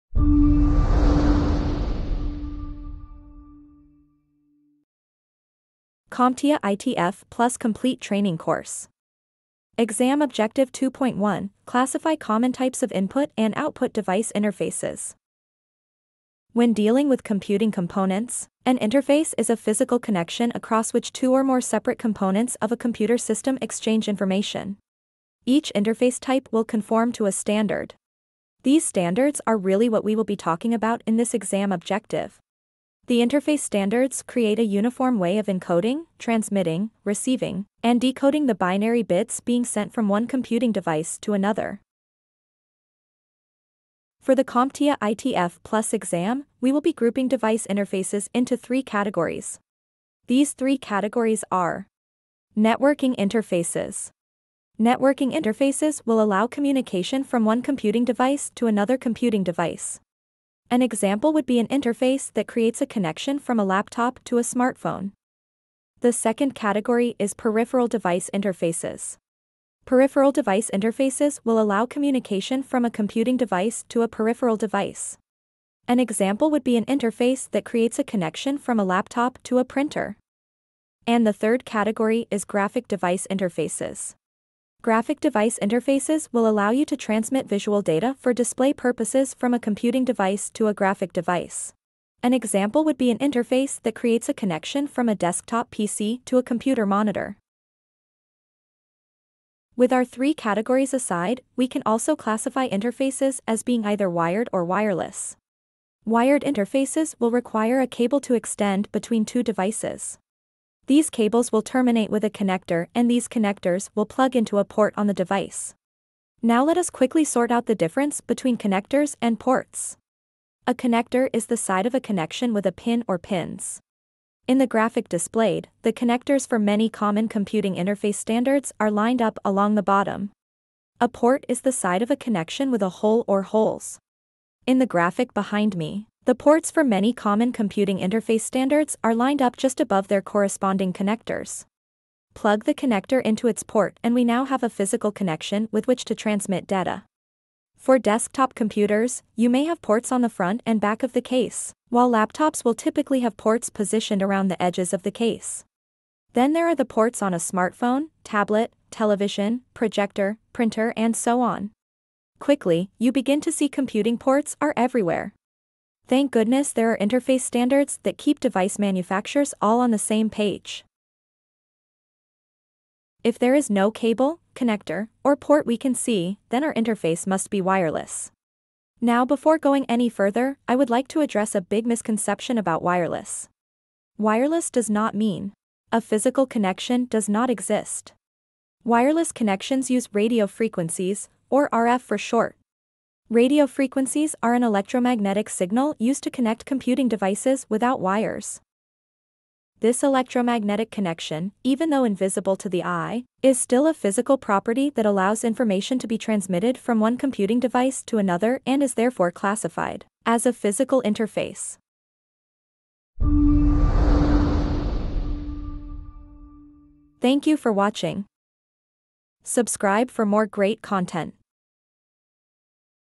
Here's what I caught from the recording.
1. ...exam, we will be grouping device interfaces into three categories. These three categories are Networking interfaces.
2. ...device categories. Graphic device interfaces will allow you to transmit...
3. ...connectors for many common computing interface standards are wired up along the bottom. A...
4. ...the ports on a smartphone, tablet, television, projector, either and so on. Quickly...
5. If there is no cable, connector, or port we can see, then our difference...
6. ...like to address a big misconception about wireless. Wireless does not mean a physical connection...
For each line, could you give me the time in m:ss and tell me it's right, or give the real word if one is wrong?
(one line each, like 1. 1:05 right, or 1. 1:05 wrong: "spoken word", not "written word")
1. 0:45 right
2. 1:22 wrong: "interfaces", not "categories"
3. 2:05 wrong: "lined", not "wired"
4. 2:36 wrong: "printer", not "either"
5. 2:53 wrong: "interface", not "difference"
6. 3:00 right.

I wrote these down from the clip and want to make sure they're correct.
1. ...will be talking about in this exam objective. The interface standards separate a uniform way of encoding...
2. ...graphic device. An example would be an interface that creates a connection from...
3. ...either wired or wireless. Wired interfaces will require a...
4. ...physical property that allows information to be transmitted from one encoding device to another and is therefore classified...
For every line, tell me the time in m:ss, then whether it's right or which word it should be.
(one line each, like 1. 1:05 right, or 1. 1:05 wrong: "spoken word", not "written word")
1. 0:30 wrong: "create", not "separate"
2. 1:30 right
3. 1:43 right
4. 3:23 wrong: "computing", not "encoding".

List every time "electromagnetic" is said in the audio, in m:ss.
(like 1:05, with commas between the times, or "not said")
3:14, 3:20.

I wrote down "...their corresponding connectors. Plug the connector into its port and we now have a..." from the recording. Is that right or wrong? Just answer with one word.
right.